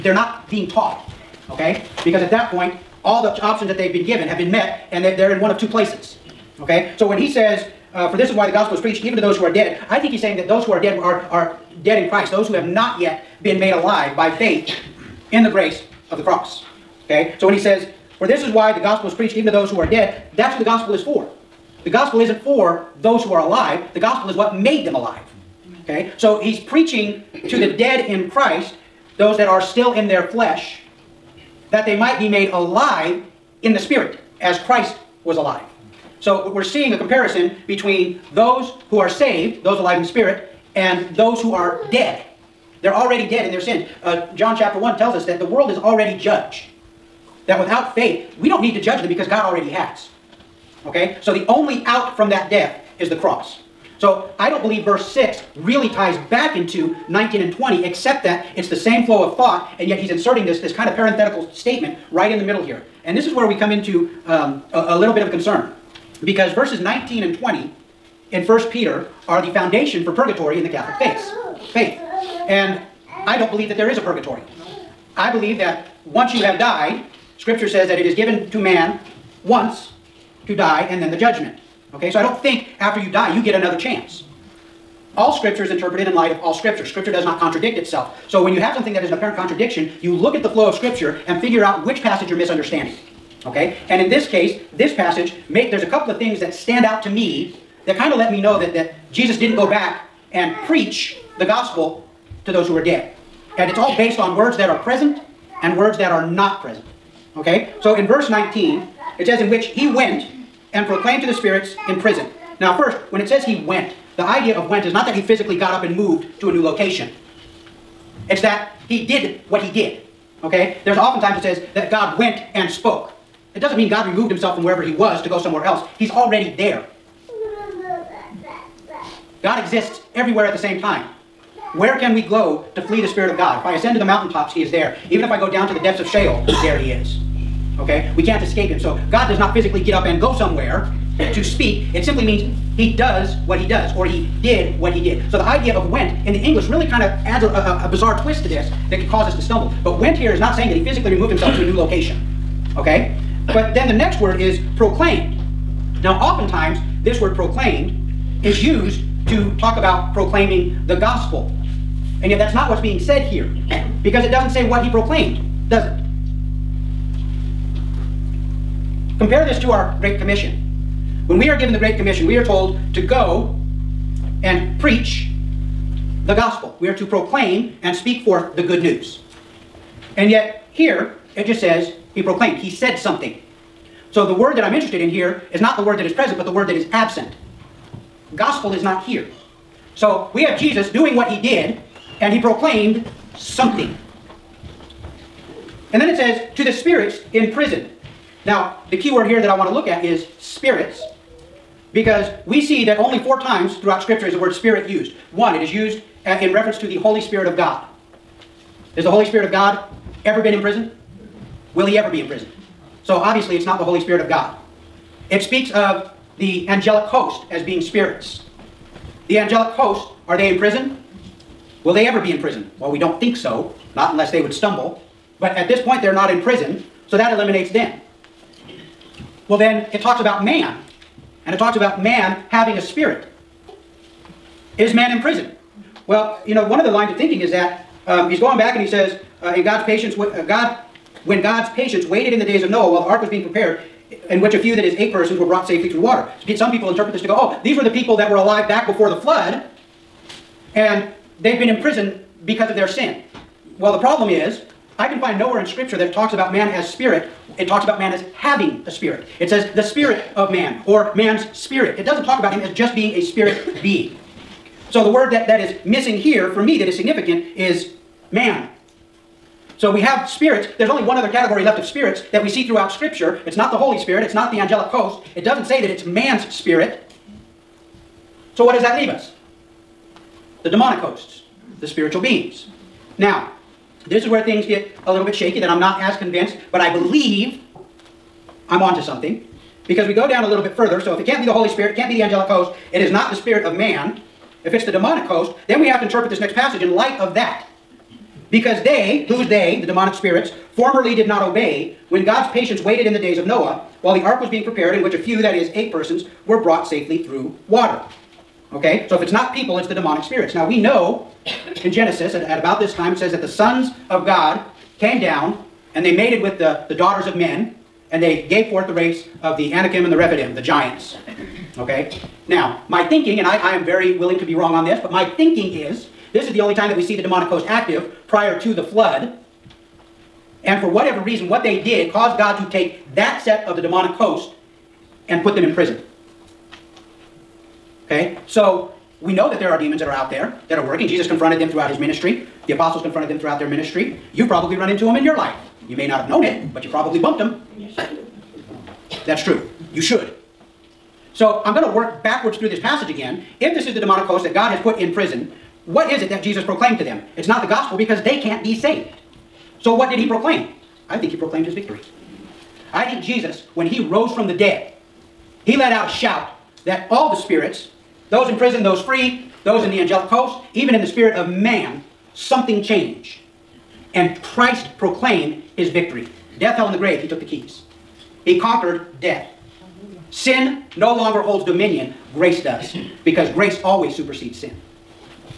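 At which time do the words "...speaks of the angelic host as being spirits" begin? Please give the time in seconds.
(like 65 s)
215 s.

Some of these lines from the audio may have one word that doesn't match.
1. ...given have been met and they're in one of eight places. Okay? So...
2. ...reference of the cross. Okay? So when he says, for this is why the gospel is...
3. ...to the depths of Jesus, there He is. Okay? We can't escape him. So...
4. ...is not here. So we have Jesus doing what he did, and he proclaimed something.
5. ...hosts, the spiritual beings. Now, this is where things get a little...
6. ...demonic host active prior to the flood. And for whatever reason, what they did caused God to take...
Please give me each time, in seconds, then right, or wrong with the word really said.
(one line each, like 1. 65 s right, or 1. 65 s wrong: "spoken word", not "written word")
1. 4 s wrong: "two", not "eight"
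2. 15 s wrong: "grace", not "reference"
3. 135 s wrong: "Sheol", not "Jesus"
4. 188 s right
5. 281 s right
6. 327 s right.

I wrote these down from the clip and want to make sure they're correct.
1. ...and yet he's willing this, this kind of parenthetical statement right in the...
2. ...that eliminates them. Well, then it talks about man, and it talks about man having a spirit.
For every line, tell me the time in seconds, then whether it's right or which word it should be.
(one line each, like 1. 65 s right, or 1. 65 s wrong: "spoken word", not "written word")
1. 59 s wrong: "inserting", not "willing"
2. 227 s right.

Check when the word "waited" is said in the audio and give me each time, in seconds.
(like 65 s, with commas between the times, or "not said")
242 s, 302 s.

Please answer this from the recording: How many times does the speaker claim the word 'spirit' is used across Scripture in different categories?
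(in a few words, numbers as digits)
4.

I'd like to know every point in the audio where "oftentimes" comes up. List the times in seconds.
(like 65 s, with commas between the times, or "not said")
120 s, 156 s.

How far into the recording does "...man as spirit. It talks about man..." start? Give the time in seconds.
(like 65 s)
256 s.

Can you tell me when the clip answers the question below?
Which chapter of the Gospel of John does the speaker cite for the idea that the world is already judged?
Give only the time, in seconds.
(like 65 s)
44 s.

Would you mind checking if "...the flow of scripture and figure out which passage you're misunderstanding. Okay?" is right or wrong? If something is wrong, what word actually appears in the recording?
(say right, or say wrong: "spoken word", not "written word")
right.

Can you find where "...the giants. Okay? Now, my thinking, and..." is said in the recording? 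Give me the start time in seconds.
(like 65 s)
320 s.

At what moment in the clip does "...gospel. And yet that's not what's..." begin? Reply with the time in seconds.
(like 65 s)
160 s.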